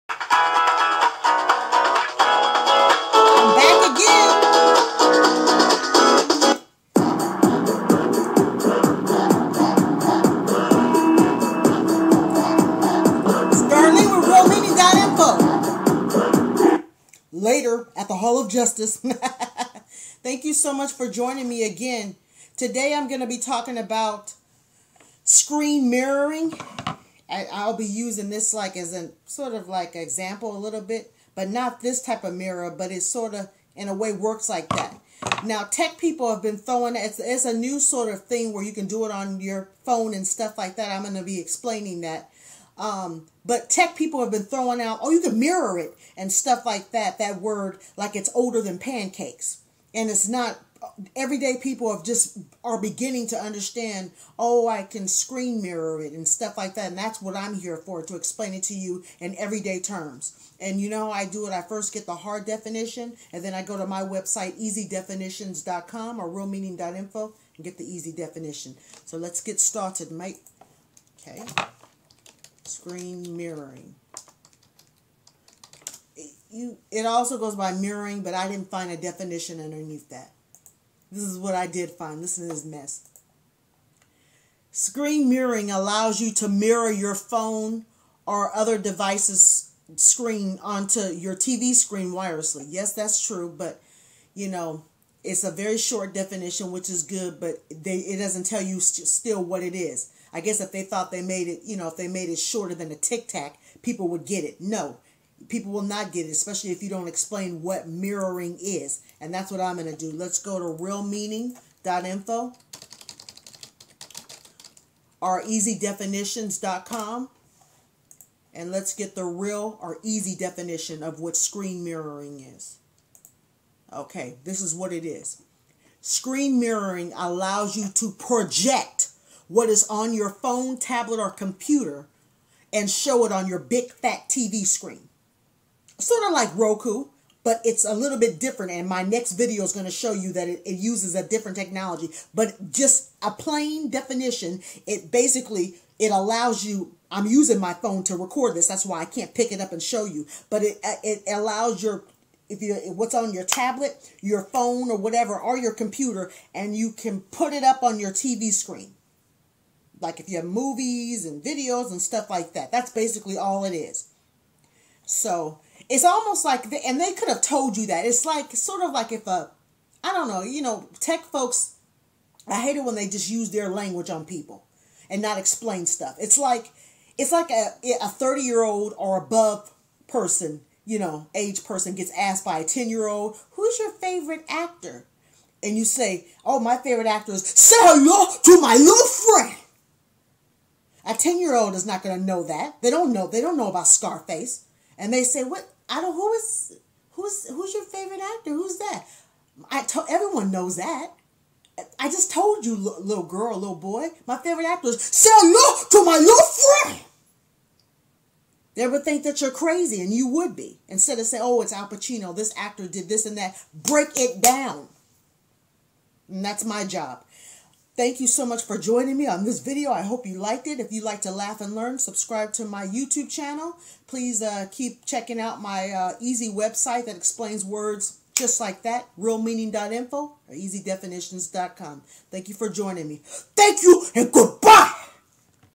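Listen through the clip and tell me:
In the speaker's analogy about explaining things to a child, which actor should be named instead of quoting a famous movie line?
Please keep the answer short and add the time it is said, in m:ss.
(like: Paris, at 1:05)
Al Pacino, at 3:31.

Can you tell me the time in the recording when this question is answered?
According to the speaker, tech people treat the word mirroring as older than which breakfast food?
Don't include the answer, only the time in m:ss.
0:48.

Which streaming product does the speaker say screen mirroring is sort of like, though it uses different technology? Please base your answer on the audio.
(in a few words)
Roku.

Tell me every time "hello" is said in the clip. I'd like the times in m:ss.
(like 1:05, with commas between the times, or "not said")
3:07, 3:25.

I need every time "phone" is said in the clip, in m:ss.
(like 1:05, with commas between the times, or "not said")
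0:39, 1:27, 2:10, 2:27, 2:34.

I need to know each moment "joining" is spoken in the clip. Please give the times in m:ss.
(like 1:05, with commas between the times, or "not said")
0:21, 3:38, 3:52.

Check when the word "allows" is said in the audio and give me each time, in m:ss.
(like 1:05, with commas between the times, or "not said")
1:25, 2:07, 2:26, 2:31.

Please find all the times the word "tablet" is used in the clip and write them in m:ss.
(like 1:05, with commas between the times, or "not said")
2:10, 2:33.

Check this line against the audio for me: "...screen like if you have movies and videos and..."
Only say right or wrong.
right.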